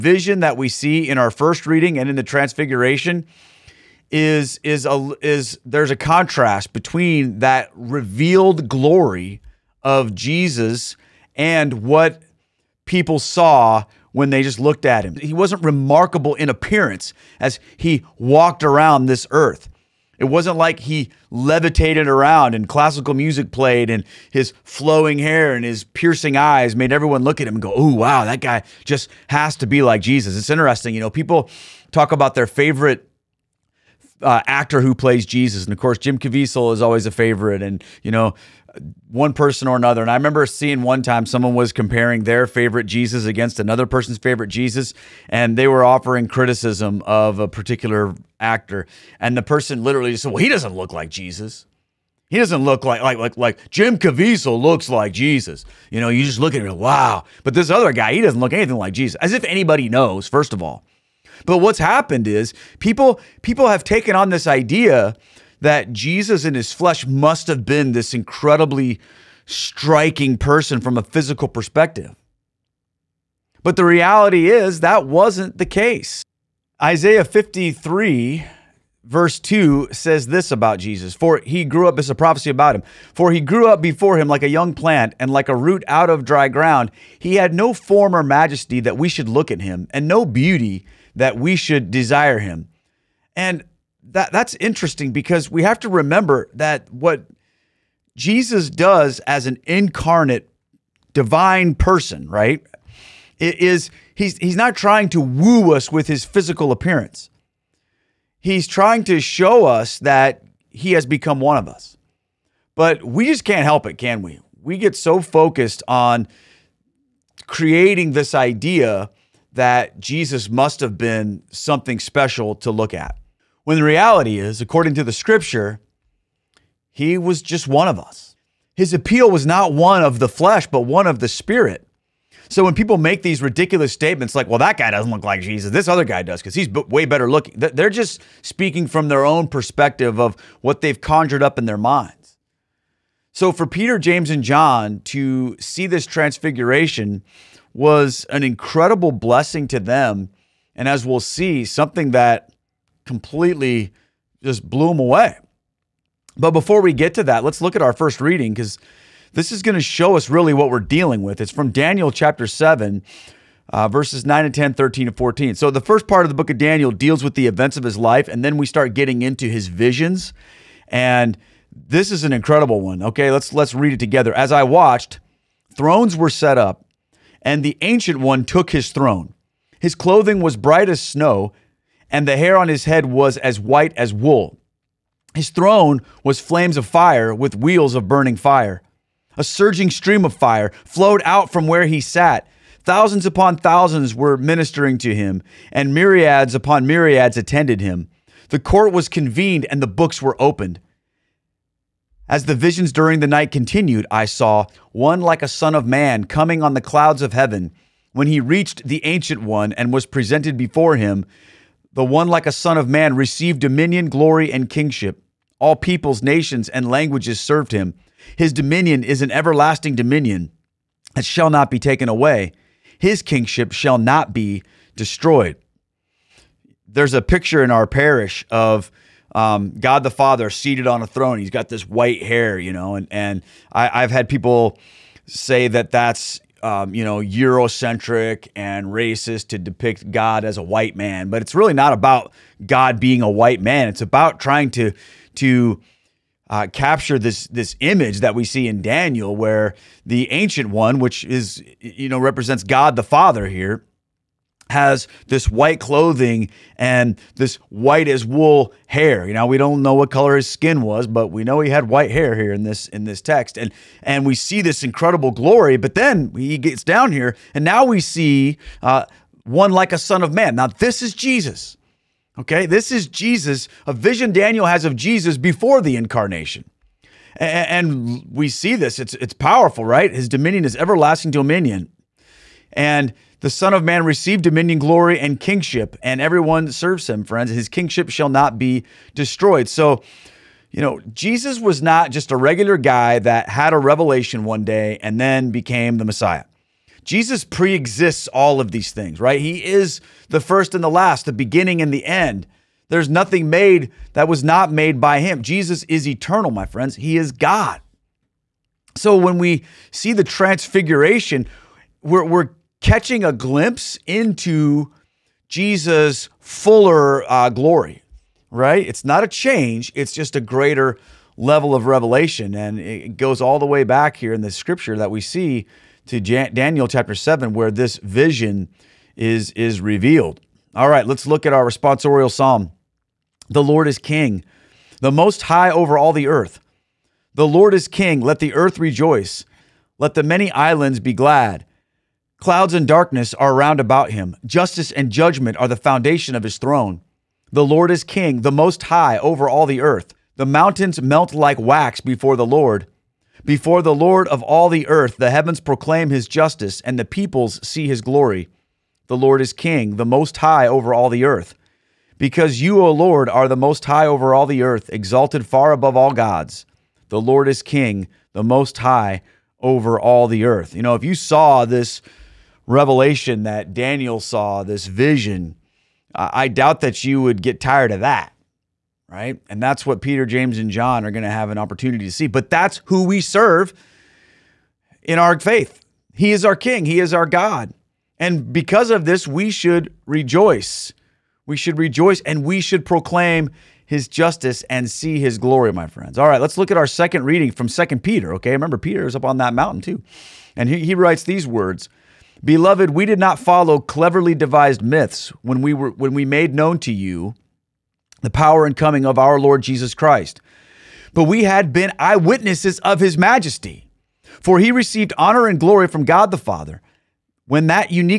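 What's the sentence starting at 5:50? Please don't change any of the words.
The mountains melt like wax before the Lord.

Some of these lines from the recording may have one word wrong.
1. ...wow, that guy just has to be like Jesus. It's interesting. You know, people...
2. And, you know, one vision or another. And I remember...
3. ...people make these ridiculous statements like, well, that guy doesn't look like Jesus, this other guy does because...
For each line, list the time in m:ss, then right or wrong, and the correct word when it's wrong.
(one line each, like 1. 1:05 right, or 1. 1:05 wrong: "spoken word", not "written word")
1. 0:27 right
2. 0:37 wrong: "person", not "vision"
3. 2:12 right.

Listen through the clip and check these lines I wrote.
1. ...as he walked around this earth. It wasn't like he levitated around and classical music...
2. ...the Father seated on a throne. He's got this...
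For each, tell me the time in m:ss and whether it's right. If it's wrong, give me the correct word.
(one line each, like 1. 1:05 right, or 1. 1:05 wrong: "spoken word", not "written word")
1. 0:17 right
2. 3:50 right.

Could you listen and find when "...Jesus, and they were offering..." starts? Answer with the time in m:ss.
0:44.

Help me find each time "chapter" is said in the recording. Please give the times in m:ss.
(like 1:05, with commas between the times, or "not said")
2:42, 5:26.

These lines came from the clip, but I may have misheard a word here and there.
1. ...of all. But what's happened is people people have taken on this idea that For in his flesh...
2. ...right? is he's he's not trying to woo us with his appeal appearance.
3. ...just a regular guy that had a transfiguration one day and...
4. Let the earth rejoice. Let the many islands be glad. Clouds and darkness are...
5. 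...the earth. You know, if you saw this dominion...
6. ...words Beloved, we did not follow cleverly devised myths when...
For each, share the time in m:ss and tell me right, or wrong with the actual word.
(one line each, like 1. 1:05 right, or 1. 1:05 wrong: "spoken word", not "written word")
1. 1:00 wrong: "Jesus", not "For"
2. 1:42 wrong: "physical", not "appeal"
3. 4:52 wrong: "revelation", not "transfiguration"
4. 5:38 right
5. 6:10 wrong: "revelation", not "dominion"
6. 6:41 right.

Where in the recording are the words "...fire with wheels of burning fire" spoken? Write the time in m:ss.
3:06.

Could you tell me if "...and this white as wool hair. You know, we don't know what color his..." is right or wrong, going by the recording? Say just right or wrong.
right.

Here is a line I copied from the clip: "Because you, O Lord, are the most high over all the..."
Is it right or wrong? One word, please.
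right.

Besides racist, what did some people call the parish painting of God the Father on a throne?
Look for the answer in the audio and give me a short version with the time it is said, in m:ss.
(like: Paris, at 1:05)
Eurocentric, at 3:57.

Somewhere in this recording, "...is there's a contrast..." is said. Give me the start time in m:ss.
0:05.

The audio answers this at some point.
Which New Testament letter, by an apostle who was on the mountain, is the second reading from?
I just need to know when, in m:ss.
6:37.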